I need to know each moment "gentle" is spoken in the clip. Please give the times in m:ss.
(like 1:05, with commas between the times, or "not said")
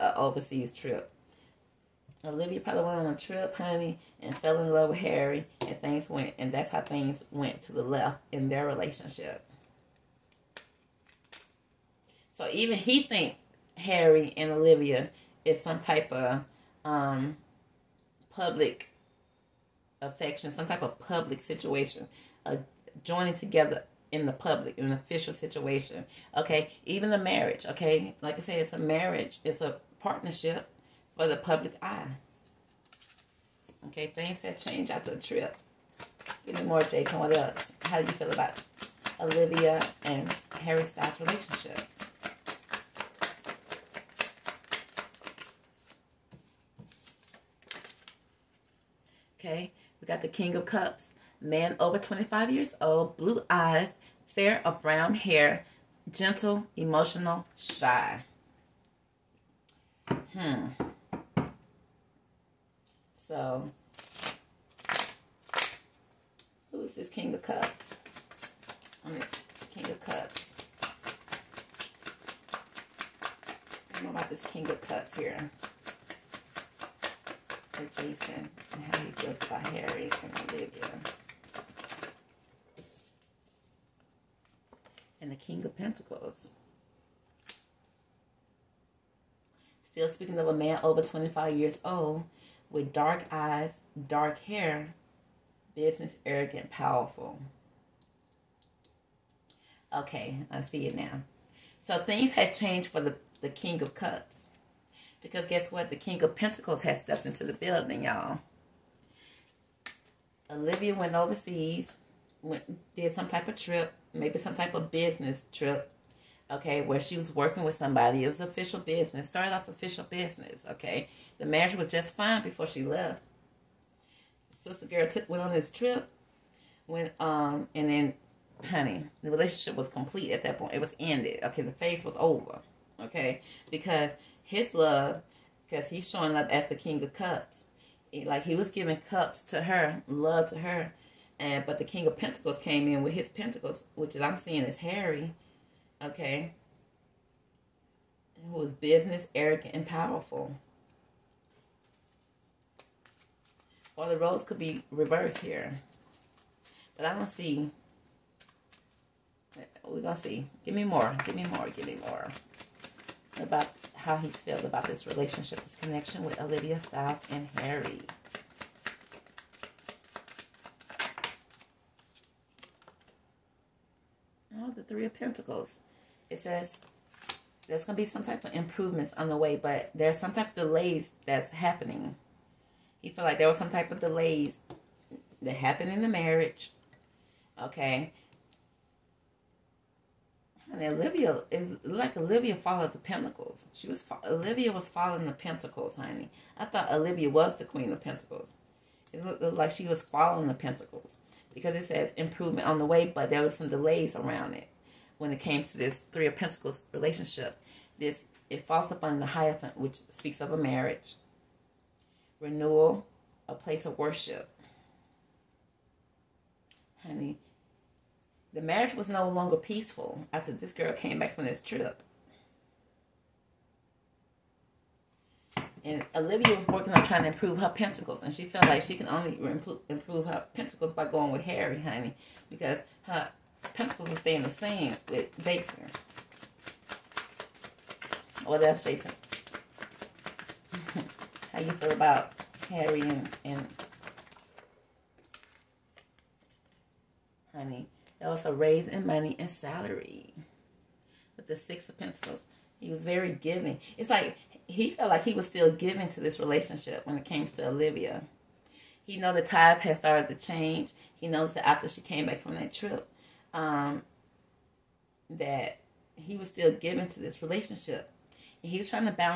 0:56.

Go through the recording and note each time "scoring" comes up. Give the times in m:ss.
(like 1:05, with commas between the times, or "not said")
not said.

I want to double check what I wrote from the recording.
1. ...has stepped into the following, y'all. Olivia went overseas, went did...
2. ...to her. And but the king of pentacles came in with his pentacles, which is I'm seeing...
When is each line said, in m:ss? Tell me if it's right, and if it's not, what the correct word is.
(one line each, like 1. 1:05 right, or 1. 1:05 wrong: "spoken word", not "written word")
1. 1:46 wrong: "building", not "following"
2. 2:20 right.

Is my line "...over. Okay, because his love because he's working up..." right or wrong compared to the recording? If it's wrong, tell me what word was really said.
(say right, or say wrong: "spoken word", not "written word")
wrong: "showing", not "working".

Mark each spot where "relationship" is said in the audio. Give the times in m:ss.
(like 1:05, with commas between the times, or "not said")
0:08, 0:41, 2:09, 2:45, 3:26, 4:16, 4:27.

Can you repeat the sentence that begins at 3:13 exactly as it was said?
She was Olivia was following the Pentacles, honey.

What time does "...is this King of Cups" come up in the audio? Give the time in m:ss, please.
1:06.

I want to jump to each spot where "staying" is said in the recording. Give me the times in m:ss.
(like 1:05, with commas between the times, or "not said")
3:54.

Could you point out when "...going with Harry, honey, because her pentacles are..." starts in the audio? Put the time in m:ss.
3:51.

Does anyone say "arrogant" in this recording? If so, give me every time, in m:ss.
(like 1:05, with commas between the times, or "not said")
1:36, 2:29.